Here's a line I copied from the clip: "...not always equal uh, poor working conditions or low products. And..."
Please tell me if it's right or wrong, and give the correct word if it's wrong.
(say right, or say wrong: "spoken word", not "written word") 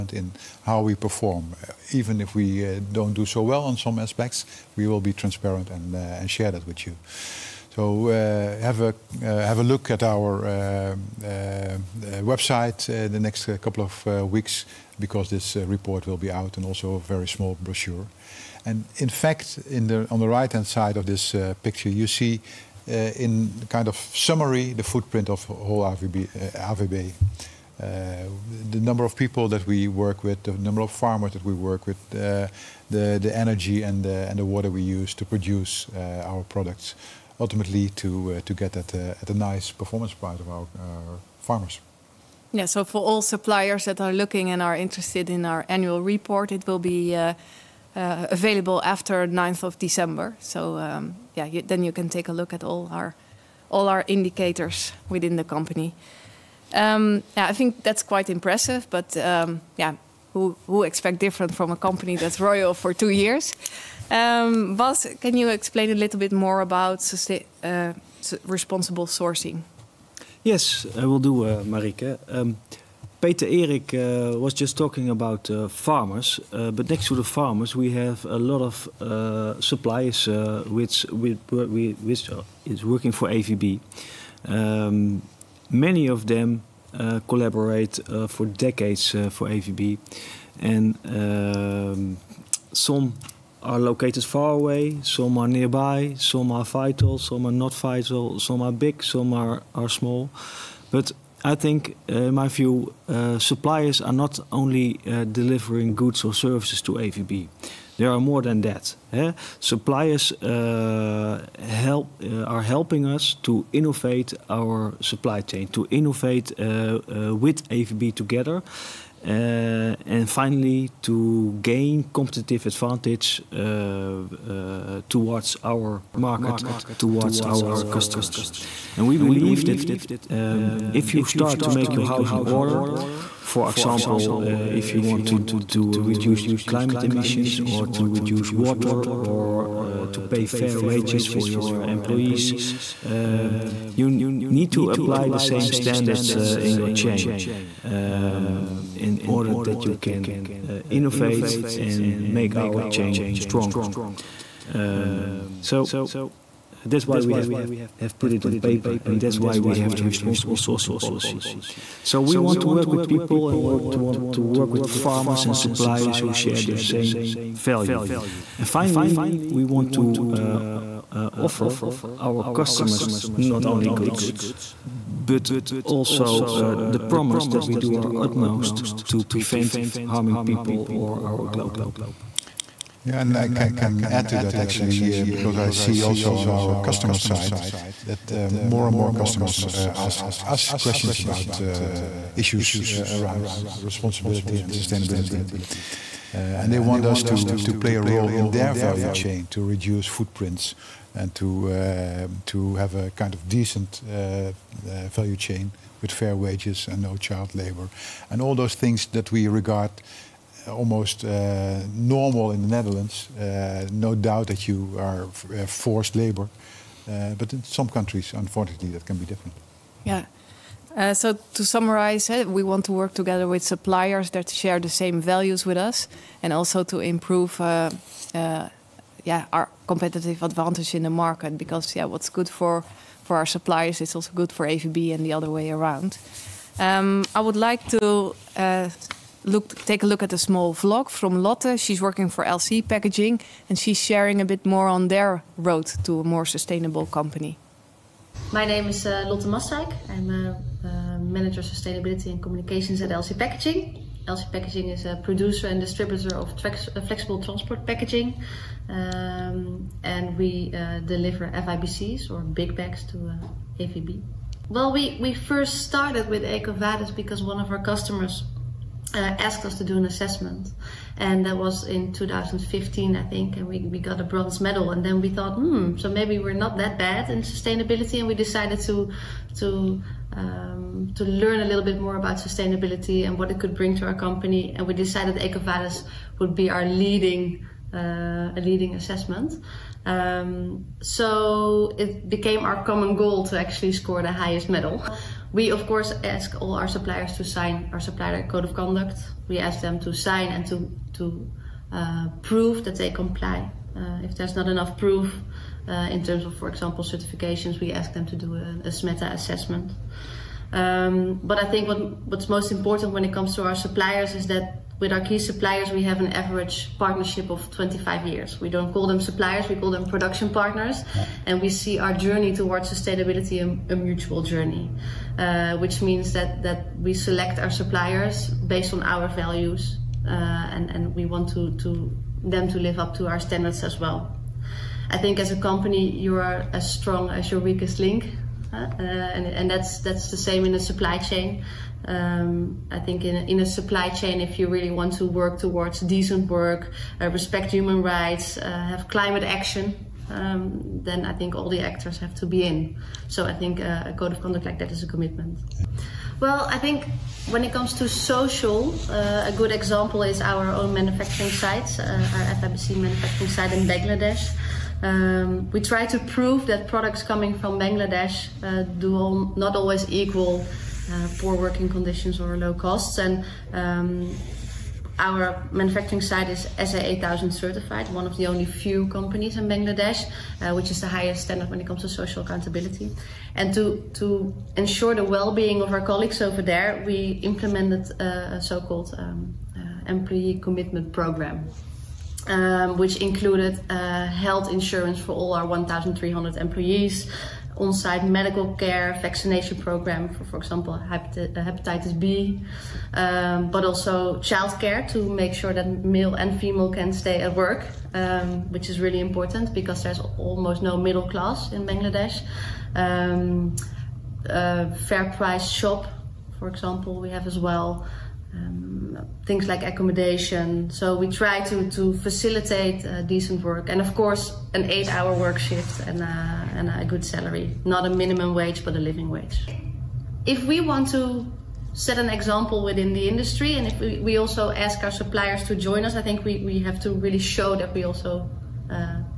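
wrong: "costs", not "products".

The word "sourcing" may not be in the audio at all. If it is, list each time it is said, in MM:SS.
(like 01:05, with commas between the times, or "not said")
01:09, 02:40.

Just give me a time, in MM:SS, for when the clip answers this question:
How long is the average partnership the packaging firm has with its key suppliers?
05:17.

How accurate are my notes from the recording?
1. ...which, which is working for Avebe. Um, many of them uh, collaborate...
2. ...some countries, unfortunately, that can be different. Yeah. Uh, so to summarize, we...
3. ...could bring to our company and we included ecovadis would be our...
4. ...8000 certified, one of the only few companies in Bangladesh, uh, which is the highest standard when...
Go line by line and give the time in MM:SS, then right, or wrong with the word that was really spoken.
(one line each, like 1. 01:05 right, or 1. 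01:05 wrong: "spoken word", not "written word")
1. 01:21 right
2. 03:37 right
3. 04:43 wrong: "decided", not "included"
4. 06:16 right.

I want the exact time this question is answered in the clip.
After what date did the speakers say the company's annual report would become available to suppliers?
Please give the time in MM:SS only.
00:49.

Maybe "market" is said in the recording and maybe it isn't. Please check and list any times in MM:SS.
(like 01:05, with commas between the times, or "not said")
02:06, 03:51.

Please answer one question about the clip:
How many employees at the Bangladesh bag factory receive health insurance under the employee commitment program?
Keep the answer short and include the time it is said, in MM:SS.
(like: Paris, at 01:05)
1,300, at 06:35.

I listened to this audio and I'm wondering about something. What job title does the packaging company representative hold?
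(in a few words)
Manager of sustainability and communications.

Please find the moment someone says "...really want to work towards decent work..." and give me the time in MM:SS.
05:44.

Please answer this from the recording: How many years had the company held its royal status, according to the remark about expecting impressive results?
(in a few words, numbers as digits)
2 years.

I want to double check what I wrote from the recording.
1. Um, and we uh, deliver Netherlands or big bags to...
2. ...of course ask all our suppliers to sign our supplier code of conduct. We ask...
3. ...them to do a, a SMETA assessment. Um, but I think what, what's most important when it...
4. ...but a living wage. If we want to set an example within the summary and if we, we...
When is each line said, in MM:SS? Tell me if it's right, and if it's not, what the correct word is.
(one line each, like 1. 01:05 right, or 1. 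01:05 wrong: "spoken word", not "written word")
1. 04:18 wrong: "FIBCs", not "Netherlands"
2. 04:55 right
3. 05:08 right
4. 07:08 wrong: "industry", not "summary".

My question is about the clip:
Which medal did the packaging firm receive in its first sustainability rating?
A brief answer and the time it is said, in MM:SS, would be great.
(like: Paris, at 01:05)
Bronze, at 04:34.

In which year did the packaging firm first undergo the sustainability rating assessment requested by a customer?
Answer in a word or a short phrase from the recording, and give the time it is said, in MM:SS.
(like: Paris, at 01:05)
2015, at 04:32.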